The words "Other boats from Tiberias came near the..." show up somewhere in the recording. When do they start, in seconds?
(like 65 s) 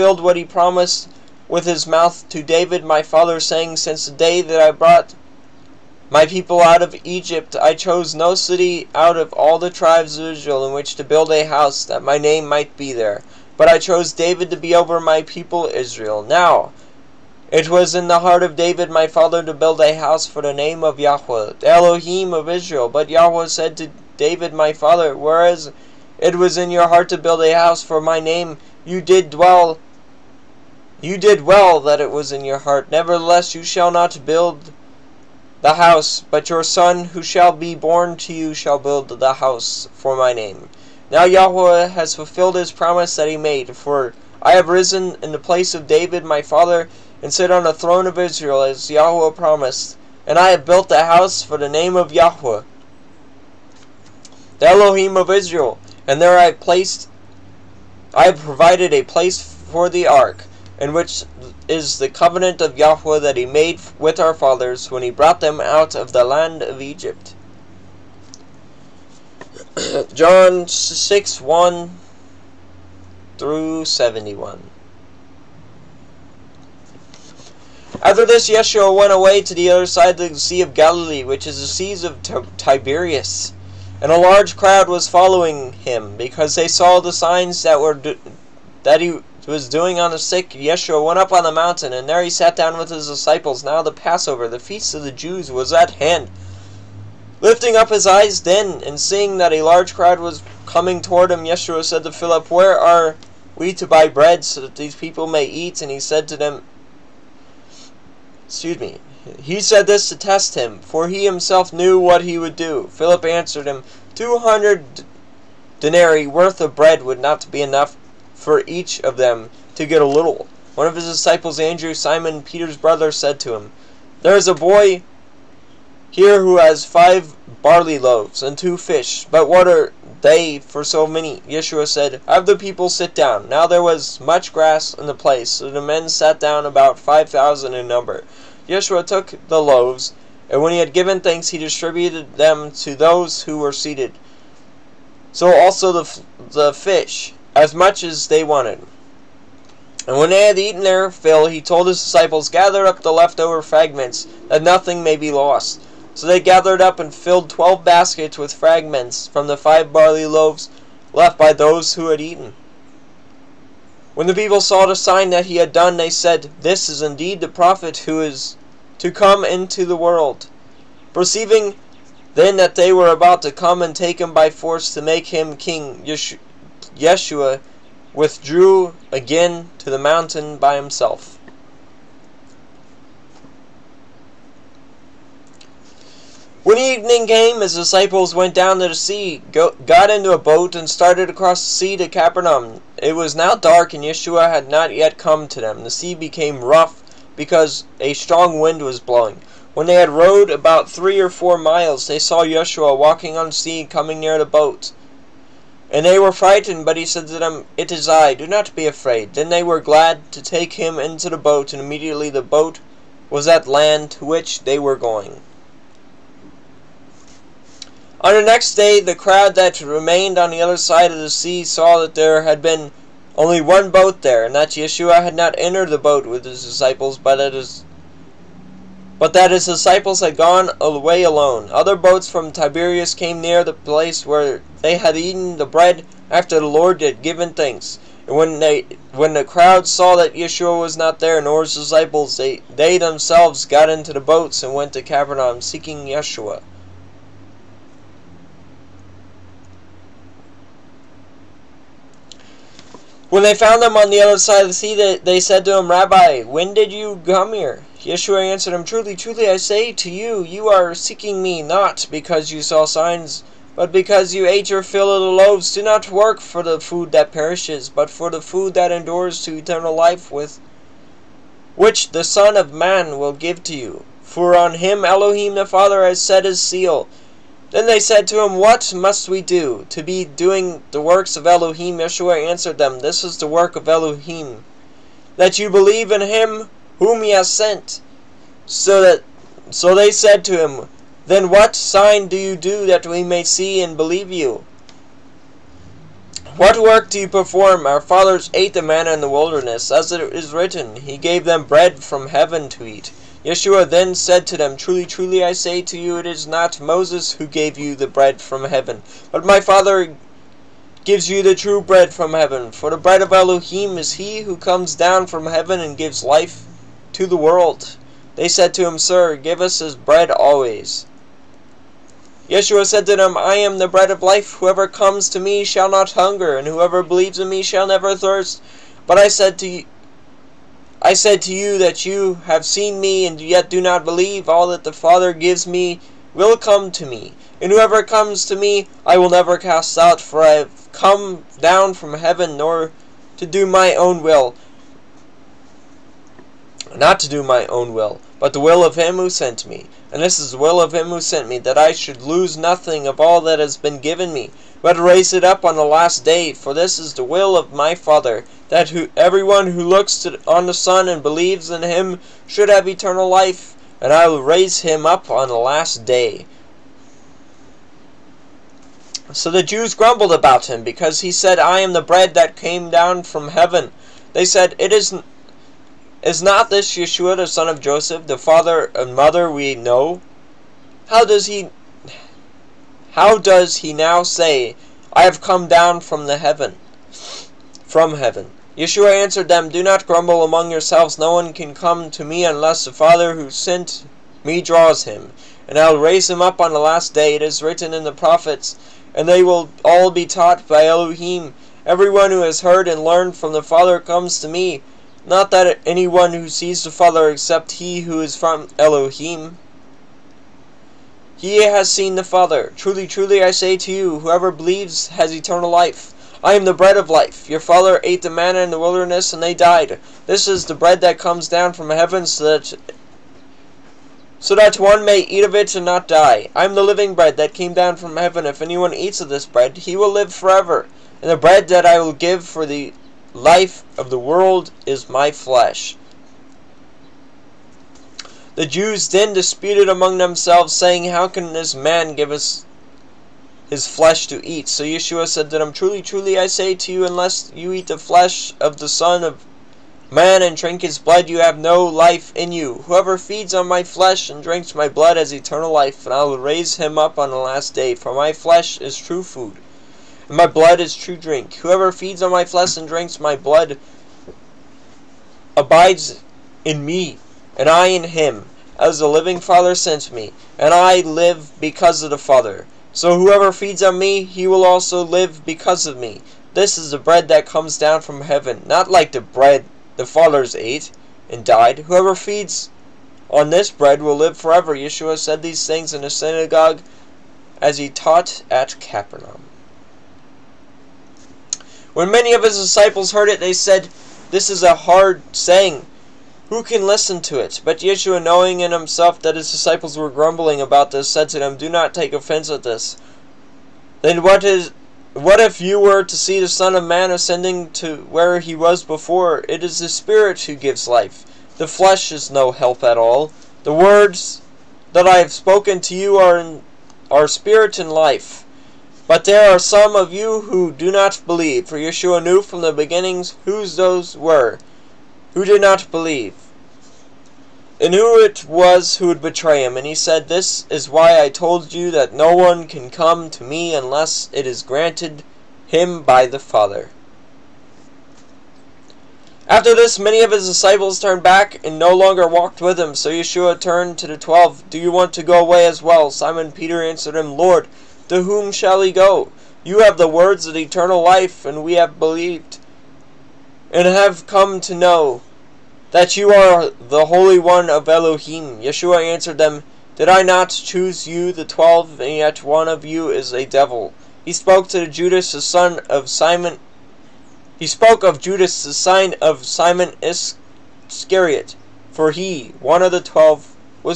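231 s.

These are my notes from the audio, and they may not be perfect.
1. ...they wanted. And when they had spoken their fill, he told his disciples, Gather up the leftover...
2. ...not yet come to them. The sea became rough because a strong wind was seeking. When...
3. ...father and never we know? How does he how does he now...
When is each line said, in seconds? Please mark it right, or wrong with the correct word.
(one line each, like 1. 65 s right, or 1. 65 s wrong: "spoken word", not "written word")
1. 148 s wrong: "eaten", not "spoken"
2. 194 s wrong: "blowing", not "seeking"
3. 378 s wrong: "mother", not "never".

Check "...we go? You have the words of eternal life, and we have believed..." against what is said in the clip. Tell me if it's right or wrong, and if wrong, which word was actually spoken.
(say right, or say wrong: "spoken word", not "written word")
right.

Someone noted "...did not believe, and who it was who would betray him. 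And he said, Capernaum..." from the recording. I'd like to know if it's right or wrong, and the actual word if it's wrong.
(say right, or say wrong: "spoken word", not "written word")
wrong: "This", not "Capernaum".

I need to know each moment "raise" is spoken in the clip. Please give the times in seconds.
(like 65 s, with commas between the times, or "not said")
354 s, 364 s, 395 s, 456 s.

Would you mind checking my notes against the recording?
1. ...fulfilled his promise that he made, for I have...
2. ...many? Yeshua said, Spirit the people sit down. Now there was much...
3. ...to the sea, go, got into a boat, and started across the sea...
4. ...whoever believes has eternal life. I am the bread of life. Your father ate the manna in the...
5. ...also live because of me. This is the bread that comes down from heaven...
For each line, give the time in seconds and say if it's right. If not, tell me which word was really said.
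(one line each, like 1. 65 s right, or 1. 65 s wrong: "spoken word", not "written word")
1. 42 s right
2. 131 s wrong: "Have", not "Spirit"
3. 188 s right
4. 414 s right
5. 474 s right.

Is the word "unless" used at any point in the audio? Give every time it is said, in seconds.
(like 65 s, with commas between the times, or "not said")
392 s, 447 s, 533 s.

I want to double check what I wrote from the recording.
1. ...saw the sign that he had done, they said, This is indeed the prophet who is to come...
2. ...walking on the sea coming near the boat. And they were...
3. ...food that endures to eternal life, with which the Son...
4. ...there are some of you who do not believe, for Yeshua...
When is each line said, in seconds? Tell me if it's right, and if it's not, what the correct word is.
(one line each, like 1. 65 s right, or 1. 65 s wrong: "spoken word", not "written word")
1. 164 s right
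2. 202 s right
3. 268 s right
4. 519 s right.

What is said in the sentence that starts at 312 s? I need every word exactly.
For the bread of Elohim is he who comes down from heaven and gives life to the world.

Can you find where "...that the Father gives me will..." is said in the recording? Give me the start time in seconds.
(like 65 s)
334 s.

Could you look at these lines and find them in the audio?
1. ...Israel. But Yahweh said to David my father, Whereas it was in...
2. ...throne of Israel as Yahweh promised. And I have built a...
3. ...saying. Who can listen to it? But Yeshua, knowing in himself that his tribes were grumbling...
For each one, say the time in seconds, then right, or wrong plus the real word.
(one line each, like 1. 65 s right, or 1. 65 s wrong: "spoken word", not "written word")
1. 22 s right
2. 47 s right
3. 495 s wrong: "disciples", not "tribes".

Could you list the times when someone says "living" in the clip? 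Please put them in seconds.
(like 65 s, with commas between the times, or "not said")
426 s, 469 s.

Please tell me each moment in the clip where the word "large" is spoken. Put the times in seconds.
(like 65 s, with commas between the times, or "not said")
84 s, 99 s.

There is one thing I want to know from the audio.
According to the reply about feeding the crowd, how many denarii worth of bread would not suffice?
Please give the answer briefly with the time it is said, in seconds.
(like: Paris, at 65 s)
200, at 114 s.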